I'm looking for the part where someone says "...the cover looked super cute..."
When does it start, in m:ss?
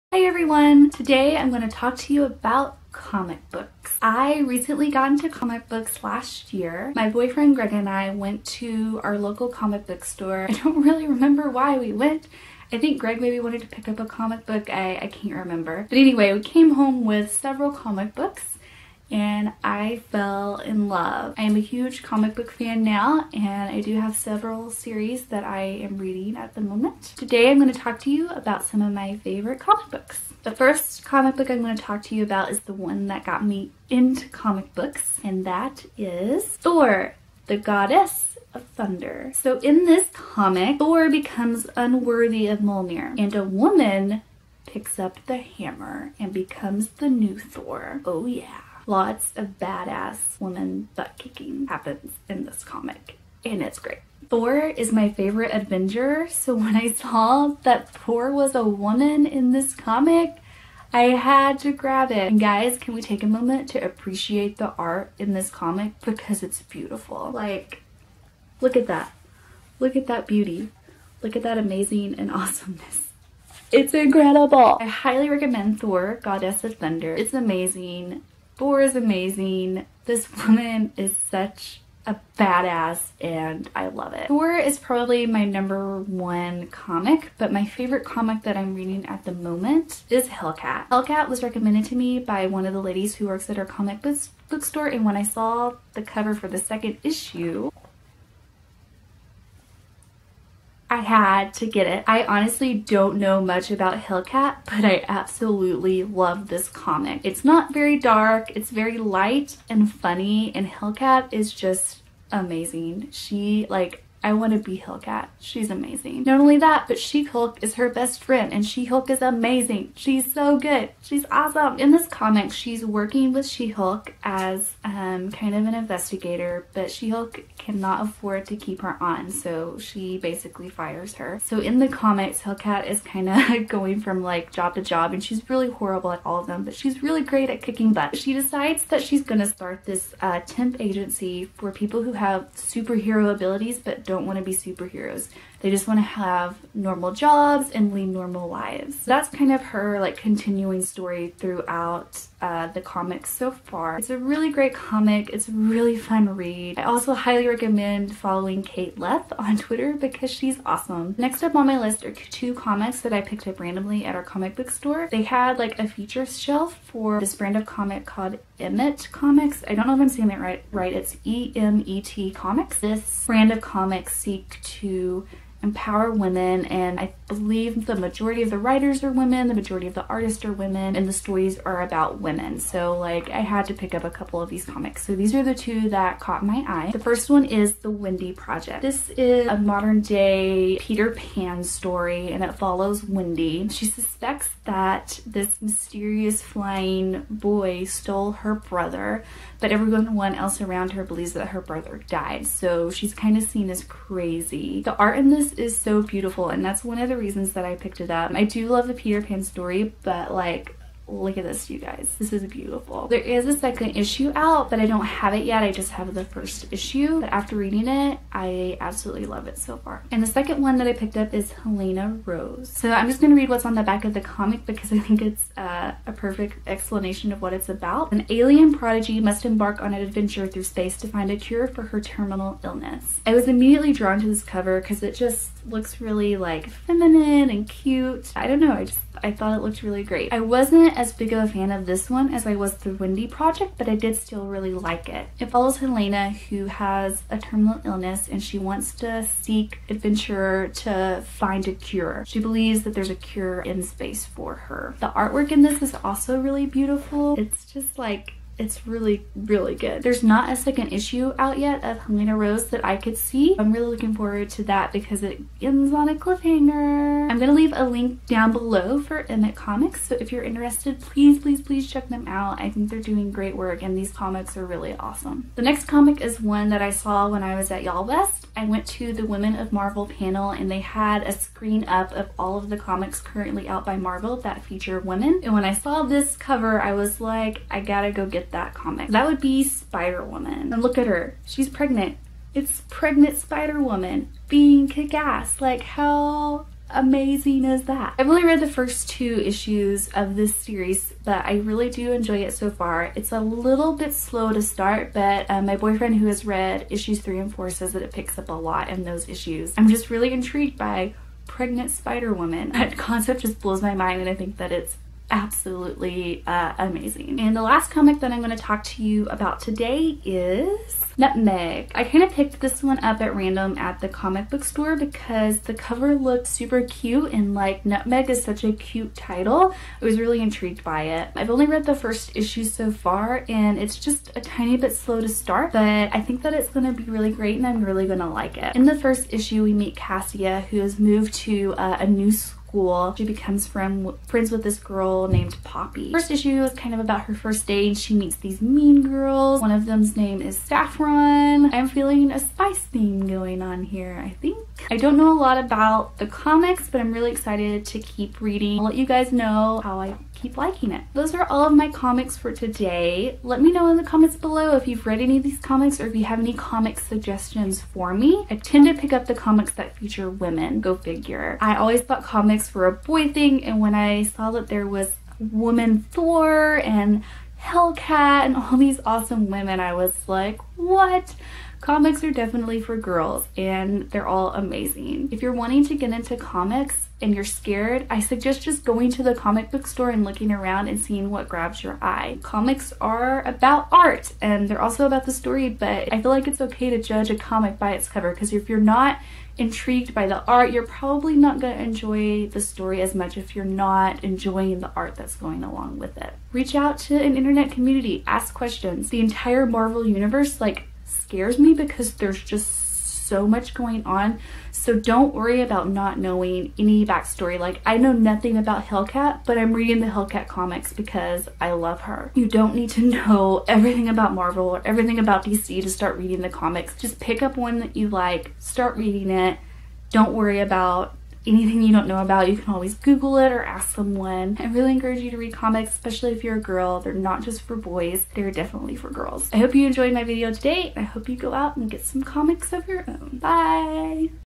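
5:25.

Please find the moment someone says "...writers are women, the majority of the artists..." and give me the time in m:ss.
2:58.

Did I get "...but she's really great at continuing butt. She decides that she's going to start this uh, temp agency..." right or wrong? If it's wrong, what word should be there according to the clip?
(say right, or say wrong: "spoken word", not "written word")
wrong: "kicking", not "continuing".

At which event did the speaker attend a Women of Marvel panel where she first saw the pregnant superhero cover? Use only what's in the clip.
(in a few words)
YALLWEST.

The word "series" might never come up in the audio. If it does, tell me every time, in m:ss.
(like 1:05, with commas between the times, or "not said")
0:24, 5:00.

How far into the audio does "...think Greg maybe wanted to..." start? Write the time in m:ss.
0:12.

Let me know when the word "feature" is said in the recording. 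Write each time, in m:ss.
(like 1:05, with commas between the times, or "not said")
2:45, 4:44, 6:09.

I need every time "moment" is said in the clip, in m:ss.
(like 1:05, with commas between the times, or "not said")
0:26, 1:03, 1:29.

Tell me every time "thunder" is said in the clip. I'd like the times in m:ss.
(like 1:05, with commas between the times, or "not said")
0:38, 1:16.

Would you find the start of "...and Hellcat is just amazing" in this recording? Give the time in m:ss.
1:50.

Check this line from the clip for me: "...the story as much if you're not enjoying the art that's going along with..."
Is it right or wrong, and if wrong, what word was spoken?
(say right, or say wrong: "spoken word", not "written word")
right.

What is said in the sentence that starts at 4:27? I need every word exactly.
I'm gonna leave a link down below for Emet Comics.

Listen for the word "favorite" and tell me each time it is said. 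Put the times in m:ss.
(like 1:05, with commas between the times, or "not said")
0:29, 0:55, 1:27.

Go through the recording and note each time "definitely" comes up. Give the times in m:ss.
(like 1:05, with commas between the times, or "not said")
6:22, 7:18.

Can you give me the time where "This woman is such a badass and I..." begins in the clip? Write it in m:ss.
1:20.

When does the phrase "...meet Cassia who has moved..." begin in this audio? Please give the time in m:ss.
5:39.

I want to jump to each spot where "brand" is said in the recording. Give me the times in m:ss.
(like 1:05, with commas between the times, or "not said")
2:47, 2:53.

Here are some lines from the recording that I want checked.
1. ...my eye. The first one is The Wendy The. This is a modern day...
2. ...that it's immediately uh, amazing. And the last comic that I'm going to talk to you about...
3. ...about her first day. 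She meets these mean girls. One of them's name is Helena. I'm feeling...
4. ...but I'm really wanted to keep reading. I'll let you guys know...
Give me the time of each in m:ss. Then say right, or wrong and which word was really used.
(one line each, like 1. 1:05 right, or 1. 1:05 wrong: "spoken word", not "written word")
1. 3:06 wrong: "Project", not "The"
2. 5:14 wrong: "absolutely", not "immediately"
3. 5:46 wrong: "Saffron", not "Helena"
4. 5:56 wrong: "excited", not "wanted".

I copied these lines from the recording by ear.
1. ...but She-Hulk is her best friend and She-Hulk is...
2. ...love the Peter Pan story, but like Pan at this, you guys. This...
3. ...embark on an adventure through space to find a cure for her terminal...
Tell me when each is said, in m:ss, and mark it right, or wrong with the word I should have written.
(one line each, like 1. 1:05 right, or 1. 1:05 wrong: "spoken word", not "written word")
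1. 1:56 right
2. 3:28 wrong: "Look", not "Pan"
3. 3:49 right.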